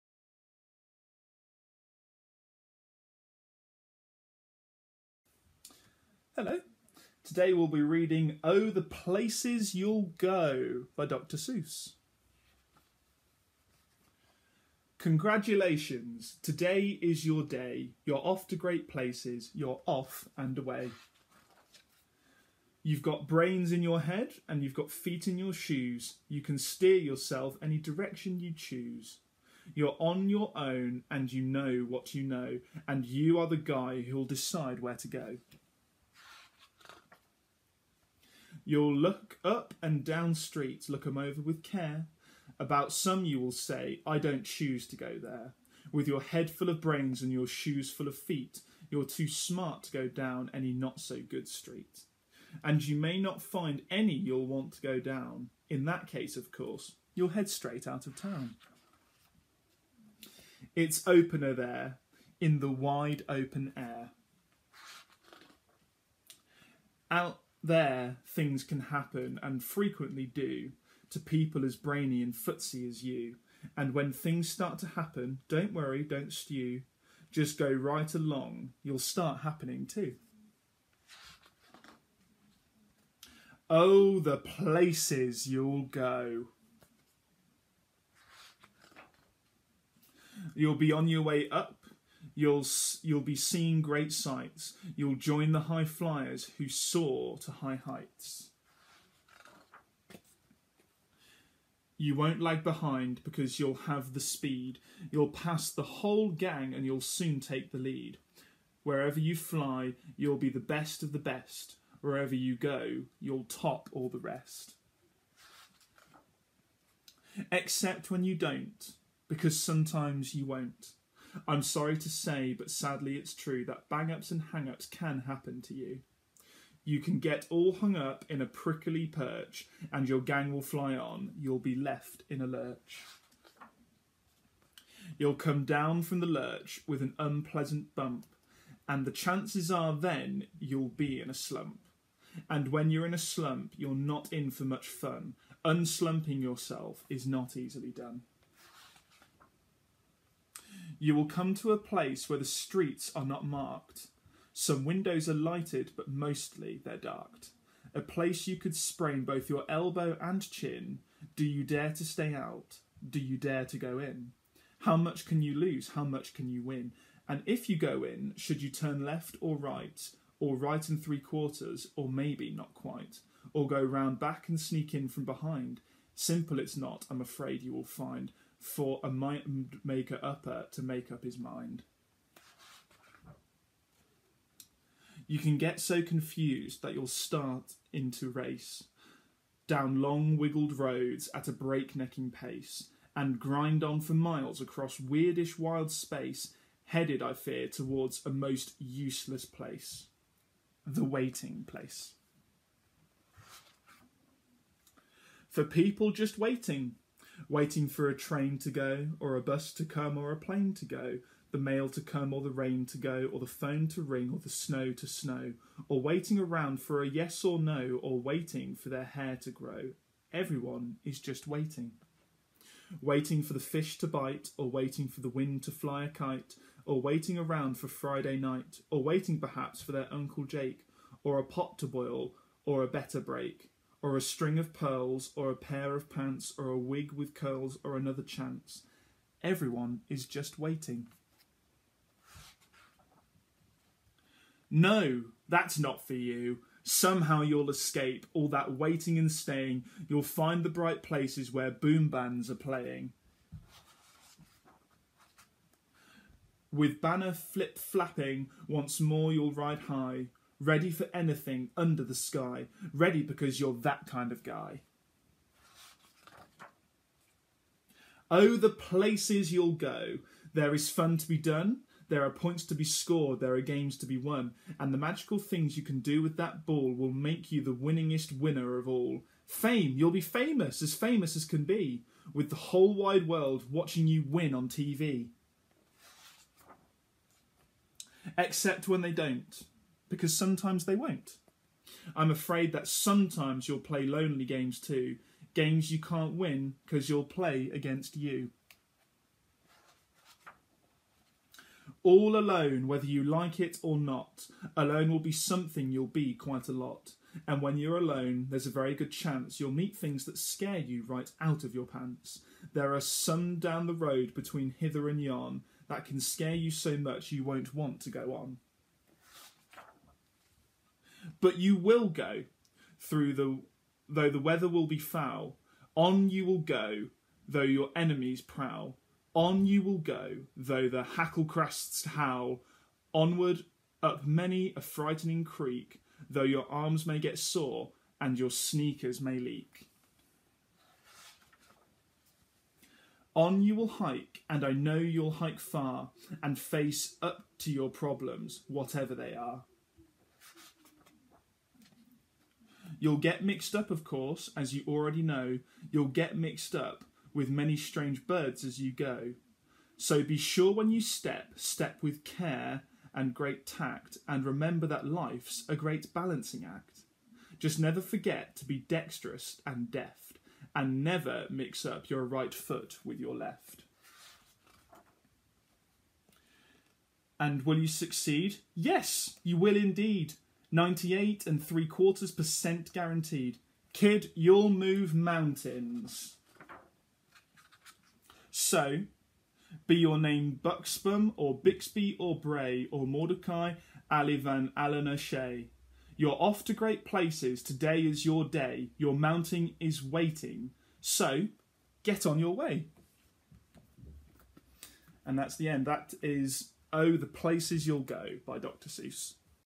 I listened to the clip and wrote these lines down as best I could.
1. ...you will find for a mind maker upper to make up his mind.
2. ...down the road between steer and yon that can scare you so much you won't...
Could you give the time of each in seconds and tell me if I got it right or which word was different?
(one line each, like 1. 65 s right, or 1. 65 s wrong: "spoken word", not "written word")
1. 177 s right
2. 313 s wrong: "hither", not "steer".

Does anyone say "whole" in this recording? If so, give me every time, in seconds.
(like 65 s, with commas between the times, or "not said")
105 s, 282 s.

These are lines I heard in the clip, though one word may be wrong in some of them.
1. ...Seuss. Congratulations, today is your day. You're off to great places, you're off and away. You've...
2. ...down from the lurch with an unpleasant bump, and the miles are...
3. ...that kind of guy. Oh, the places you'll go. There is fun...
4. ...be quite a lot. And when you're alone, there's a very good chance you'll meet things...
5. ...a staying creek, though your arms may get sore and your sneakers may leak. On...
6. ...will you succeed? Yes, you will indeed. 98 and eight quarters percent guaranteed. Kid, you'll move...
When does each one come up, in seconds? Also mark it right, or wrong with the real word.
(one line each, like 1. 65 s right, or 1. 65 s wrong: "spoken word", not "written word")
1. 11 s right
2. 135 s wrong: "chances", not "miles"
3. 263 s right
4. 306 s right
5. 334 s wrong: "frightening", not "staying"
6. 377 s wrong: "three", not "eight".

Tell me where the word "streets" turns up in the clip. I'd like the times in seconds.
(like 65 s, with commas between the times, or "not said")
40 s, 51 s, 152 s.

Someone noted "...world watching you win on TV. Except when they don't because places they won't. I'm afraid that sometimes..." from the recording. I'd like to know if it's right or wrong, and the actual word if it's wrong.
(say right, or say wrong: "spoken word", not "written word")
wrong: "sometimes", not "places".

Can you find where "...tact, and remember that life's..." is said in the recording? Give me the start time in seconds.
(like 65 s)
363 s.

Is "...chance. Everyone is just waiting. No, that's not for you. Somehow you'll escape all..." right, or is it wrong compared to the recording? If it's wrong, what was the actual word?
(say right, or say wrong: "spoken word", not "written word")
right.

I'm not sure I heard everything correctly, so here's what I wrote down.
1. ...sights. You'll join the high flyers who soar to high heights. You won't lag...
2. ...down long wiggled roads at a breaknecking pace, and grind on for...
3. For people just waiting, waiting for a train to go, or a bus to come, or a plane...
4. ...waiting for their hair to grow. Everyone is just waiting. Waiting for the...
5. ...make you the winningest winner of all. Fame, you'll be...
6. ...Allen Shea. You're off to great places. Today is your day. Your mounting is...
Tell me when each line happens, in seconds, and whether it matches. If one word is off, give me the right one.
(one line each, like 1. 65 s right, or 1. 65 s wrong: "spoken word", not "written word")
1. 94 s right
2. 189 s right
3. 205 s right
4. 218 s right
5. 277 s right
6. 394 s right.